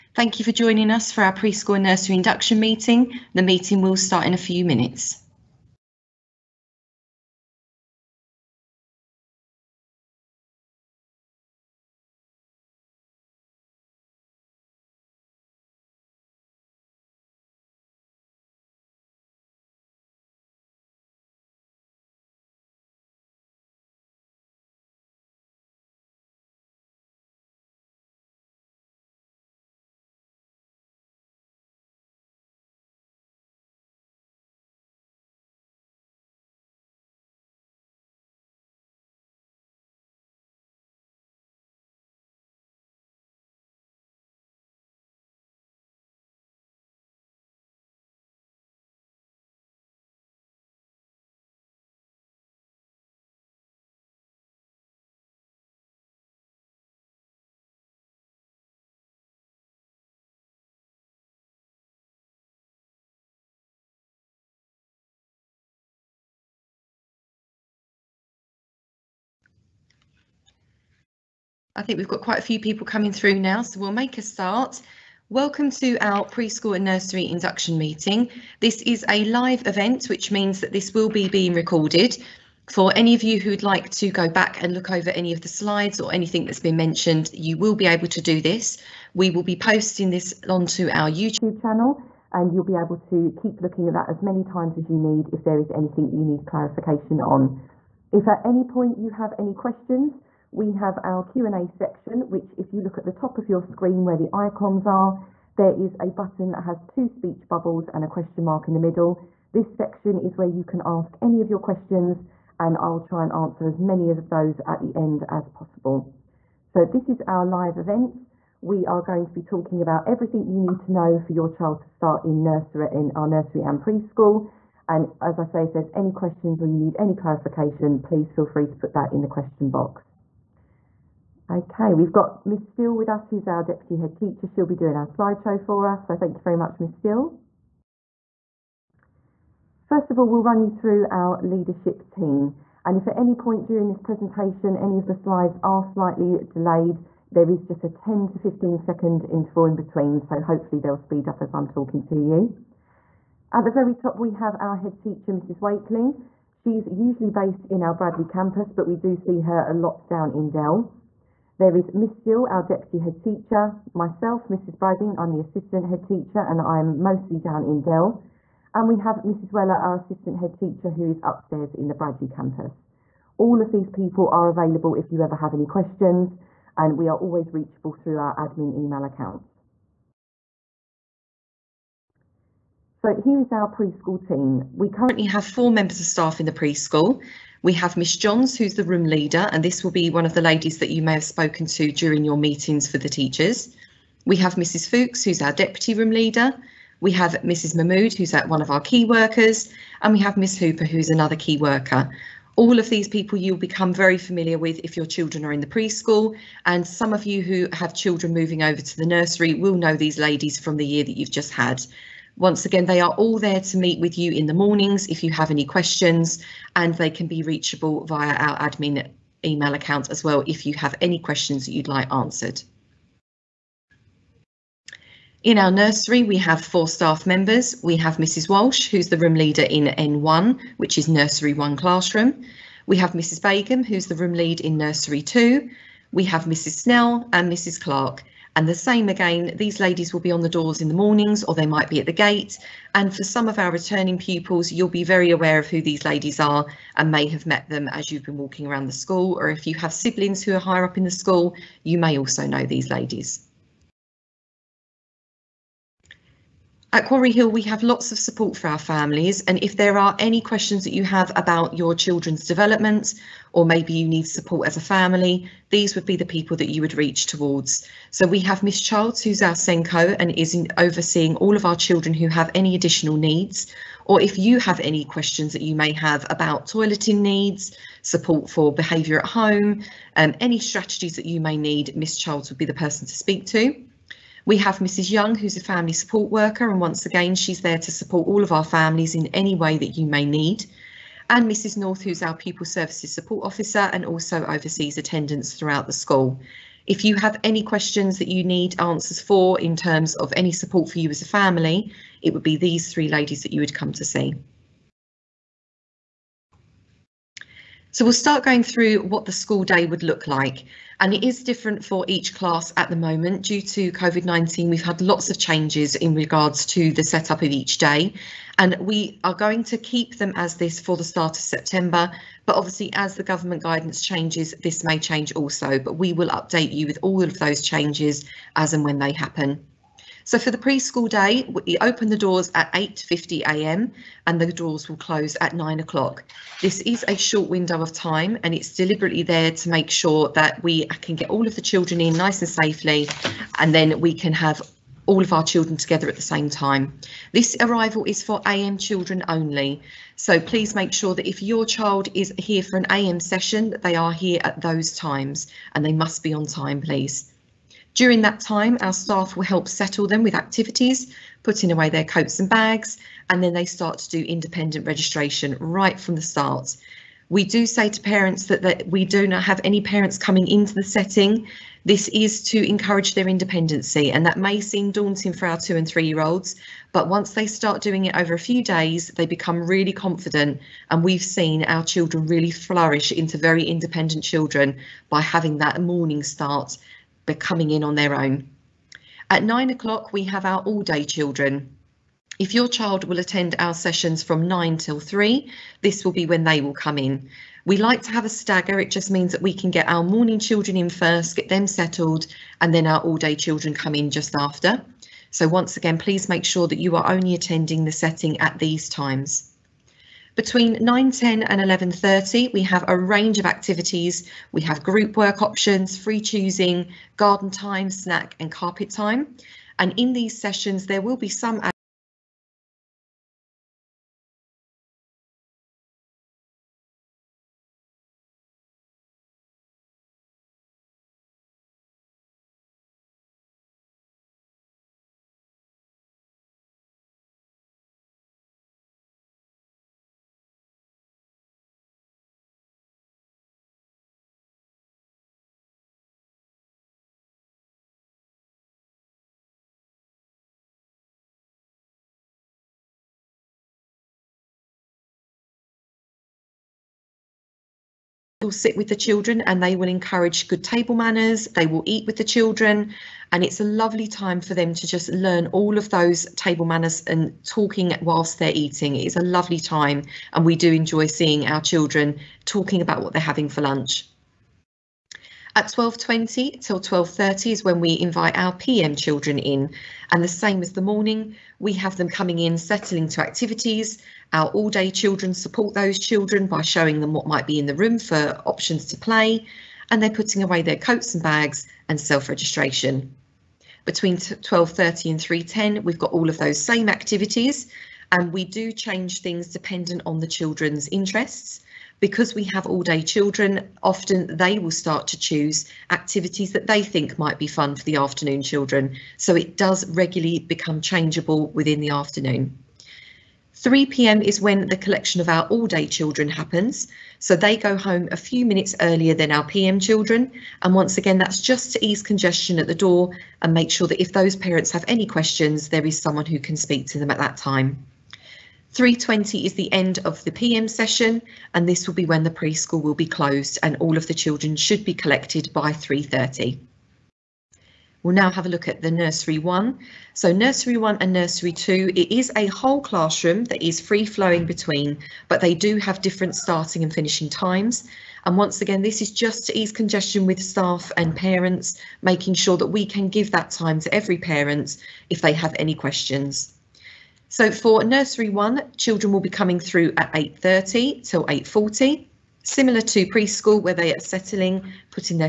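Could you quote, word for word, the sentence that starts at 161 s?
There is Miss Steele, our deputy head teacher, myself, Mrs.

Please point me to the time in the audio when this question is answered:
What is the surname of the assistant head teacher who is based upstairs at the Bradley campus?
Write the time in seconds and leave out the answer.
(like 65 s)
169 s.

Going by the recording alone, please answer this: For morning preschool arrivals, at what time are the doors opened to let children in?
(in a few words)
8.50am.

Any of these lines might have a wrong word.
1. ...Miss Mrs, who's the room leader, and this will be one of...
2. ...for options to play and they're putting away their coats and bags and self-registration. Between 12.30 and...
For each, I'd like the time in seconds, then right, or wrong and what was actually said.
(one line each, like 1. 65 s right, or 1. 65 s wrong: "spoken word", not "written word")
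1. 187 s wrong: "Johns", not "Mrs"
2. 487 s right.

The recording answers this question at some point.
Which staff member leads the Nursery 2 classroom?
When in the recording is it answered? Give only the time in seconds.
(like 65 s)
233 s.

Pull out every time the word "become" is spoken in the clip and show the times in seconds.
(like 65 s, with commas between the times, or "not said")
203 s, 379 s, 510 s.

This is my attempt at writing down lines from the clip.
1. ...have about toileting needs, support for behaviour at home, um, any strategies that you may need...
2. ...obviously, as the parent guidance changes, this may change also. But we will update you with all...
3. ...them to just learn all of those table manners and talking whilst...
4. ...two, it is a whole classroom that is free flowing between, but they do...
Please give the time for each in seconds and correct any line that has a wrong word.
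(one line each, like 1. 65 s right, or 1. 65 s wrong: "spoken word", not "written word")
1. 275 s right
2. 322 s wrong: "government", not "parent"
3. 464 s right
4. 541 s right.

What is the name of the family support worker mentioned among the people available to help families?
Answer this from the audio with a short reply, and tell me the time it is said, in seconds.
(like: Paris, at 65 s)
Mrs. Young, at 284 s.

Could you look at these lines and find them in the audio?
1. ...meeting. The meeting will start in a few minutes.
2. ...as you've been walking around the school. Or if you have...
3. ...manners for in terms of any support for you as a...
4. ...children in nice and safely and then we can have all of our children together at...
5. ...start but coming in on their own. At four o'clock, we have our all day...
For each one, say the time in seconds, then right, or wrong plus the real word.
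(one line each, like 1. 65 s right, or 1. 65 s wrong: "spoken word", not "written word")
1. 2 s right
2. 247 s right
3. 298 s wrong: "answers", not "manners"
4. 341 s right
5. 386 s wrong: "nine", not "four".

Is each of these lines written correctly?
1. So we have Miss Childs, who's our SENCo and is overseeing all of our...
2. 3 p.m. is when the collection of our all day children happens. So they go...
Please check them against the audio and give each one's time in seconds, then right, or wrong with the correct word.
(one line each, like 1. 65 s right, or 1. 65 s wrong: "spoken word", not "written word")
1. 268 s right
2. 513 s right.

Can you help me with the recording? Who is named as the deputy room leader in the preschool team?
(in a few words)
Mrs. Fuchs.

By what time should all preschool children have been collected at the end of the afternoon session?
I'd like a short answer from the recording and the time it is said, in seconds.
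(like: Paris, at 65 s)
3.30, at 535 s.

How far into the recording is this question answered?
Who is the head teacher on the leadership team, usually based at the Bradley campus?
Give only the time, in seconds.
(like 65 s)
155 s.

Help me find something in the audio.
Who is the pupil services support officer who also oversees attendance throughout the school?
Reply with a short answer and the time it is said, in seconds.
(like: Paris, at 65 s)
Mrs. North, at 291 s.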